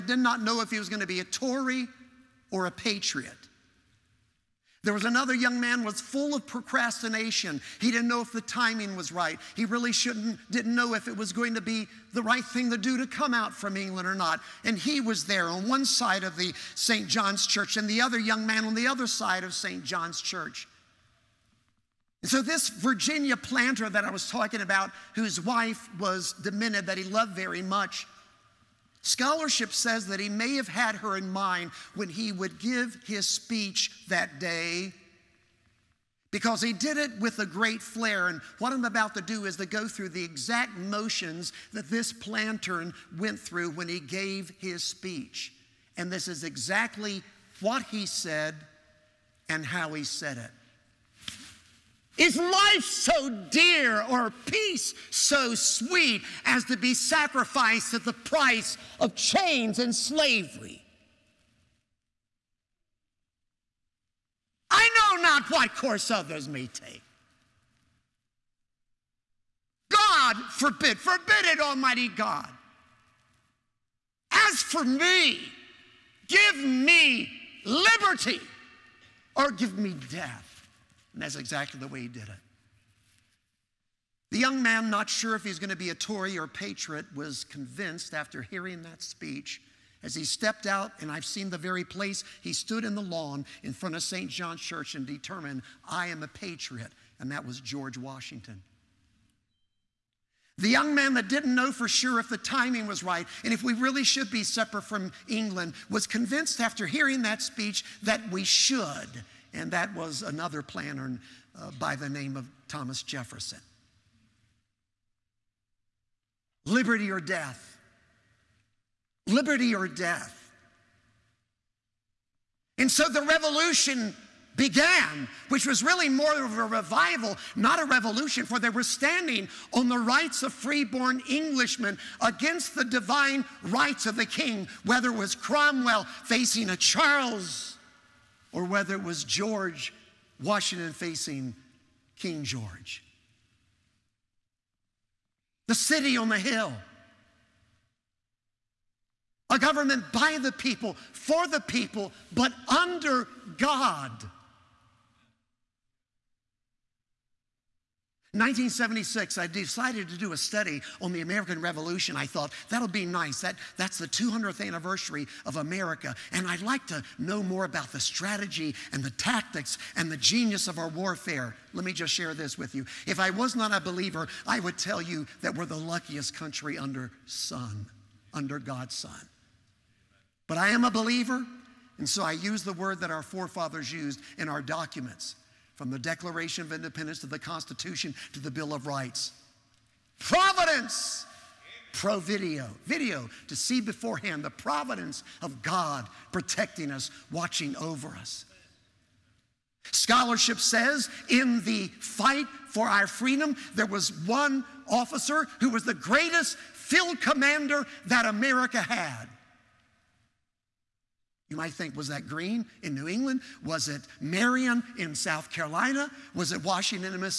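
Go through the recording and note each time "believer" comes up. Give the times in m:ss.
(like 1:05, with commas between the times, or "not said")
2:53, 3:00.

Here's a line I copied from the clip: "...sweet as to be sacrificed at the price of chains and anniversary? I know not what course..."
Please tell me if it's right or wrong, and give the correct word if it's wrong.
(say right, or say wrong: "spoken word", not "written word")
wrong: "slavery", not "anniversary".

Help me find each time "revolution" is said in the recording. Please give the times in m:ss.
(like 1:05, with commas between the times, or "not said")
2:03, 2:07, 2:41.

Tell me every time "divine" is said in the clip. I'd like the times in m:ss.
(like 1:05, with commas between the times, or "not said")
2:12.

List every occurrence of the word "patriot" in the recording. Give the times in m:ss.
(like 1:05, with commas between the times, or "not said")
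0:02, 1:26, 1:36.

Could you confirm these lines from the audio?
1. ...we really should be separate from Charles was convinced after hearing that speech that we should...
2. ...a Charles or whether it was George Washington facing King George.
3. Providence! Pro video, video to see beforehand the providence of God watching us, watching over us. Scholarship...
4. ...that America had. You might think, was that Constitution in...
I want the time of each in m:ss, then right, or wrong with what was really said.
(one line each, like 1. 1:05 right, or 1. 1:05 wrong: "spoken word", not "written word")
1. 1:43 wrong: "England", not "Charles"
2. 2:16 right
3. 3:10 wrong: "protecting", not "watching"
4. 3:28 wrong: "Greene", not "Constitution".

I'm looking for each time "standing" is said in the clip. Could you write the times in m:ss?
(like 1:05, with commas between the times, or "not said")
2:08.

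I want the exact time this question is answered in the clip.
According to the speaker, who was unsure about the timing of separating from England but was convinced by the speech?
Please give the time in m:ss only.
1:52.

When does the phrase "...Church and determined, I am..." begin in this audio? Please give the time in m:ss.
1:34.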